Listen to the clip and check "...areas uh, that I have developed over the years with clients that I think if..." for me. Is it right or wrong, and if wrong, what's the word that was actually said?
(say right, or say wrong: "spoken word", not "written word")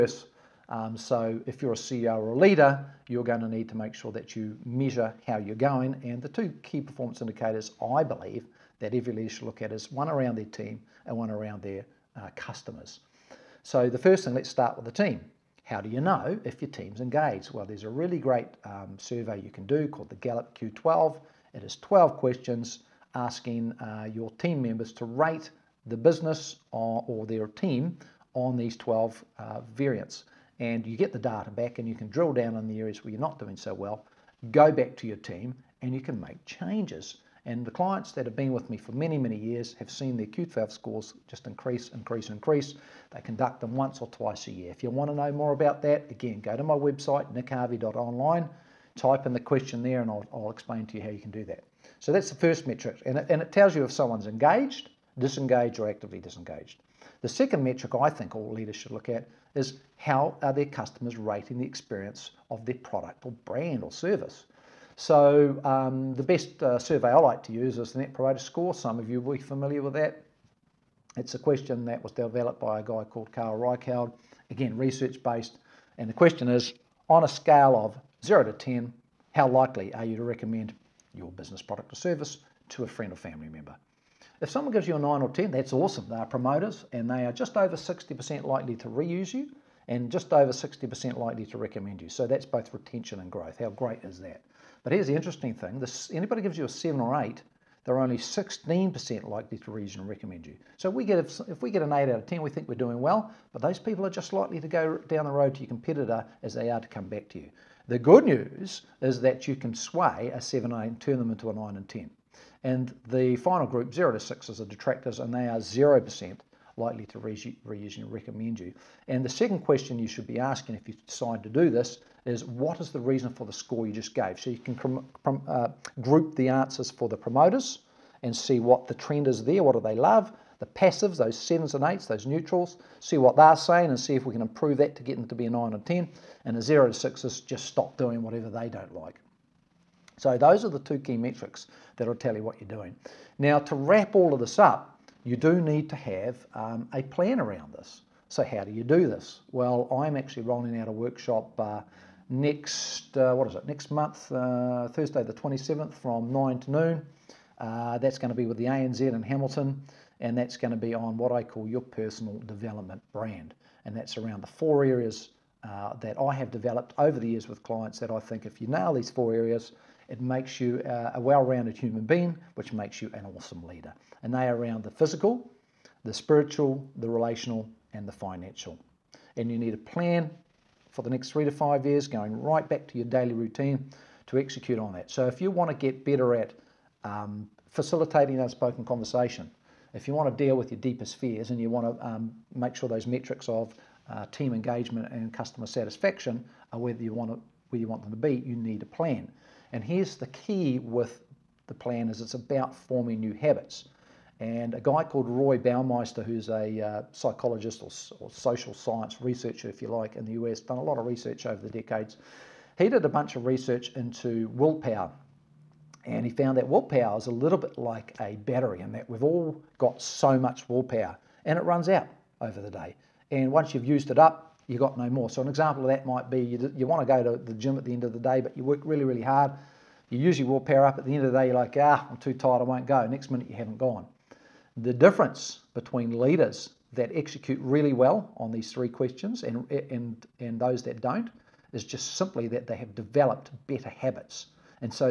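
right.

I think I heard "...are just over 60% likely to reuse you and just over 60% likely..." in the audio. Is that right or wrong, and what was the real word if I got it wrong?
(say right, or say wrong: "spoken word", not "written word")
right.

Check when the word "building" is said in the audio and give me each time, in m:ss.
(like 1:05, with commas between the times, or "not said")
not said.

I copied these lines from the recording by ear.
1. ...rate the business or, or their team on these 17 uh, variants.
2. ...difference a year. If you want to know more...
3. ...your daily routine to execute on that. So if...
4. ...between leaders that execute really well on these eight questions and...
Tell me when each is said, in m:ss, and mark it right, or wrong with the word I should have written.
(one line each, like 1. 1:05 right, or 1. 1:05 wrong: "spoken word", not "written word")
1. 0:25 wrong: "12", not "17"
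2. 0:44 wrong: "twice", not "difference"
3. 3:02 right
4. 3:55 wrong: "three", not "eight".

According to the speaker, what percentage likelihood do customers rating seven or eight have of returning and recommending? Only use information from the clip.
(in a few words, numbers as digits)
16%.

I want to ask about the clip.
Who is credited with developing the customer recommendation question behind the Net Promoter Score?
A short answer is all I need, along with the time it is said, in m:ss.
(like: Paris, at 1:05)
Carl Reichheld, at 1:13.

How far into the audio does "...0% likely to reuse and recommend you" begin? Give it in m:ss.
1:55.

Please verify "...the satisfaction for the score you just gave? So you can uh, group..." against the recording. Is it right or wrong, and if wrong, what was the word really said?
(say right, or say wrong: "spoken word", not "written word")
wrong: "reason", not "satisfaction".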